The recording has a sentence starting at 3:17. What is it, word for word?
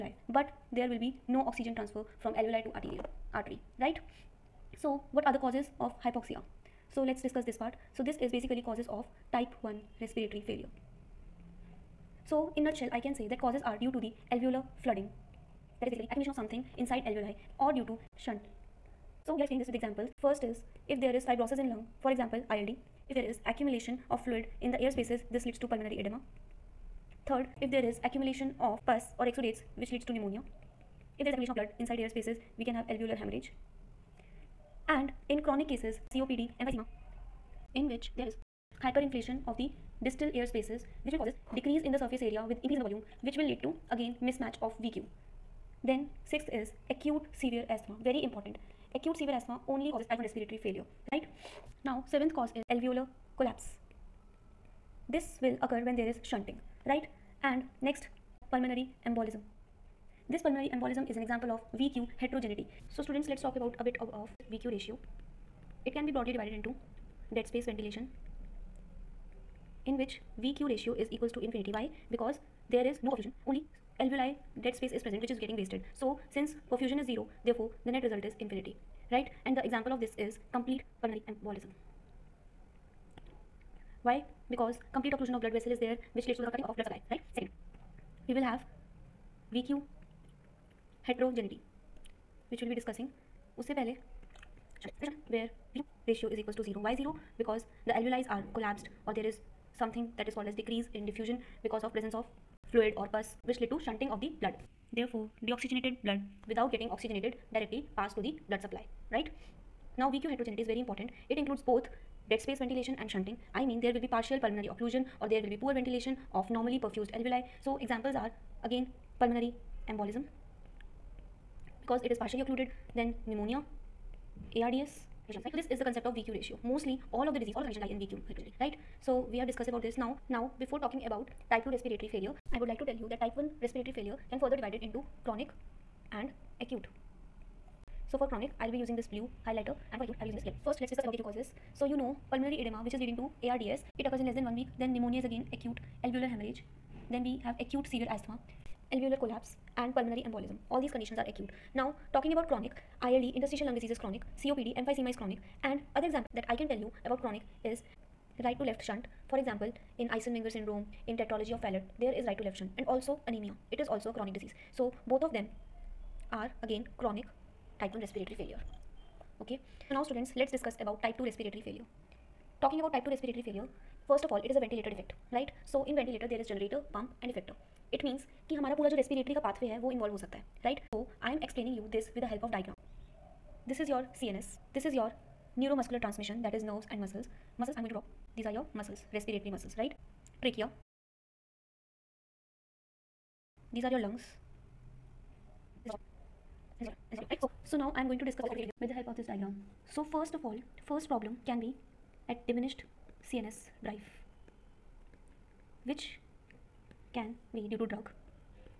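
So now I am going to discuss with the help of this diagram.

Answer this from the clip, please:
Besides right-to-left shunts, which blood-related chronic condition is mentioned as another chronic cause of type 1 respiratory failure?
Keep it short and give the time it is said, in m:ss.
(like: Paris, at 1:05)
anemia, at 2:43.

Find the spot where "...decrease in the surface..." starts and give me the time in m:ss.
0:41.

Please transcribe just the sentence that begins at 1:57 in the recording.
So examples are again pulmonary embolism because it is partially occluded then pneumonia ARDS Right.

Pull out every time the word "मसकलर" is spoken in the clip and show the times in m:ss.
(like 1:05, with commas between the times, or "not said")
3:05.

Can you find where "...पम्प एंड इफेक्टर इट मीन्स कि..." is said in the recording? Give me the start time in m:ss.
2:56.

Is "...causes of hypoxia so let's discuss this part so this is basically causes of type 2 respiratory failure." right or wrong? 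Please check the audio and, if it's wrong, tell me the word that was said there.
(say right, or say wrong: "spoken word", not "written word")
wrong: "1", not "2".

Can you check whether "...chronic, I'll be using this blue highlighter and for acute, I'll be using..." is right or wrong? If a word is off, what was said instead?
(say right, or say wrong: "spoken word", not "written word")
right.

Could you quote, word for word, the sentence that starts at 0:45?
Then sixth is acute severe asthma, very important.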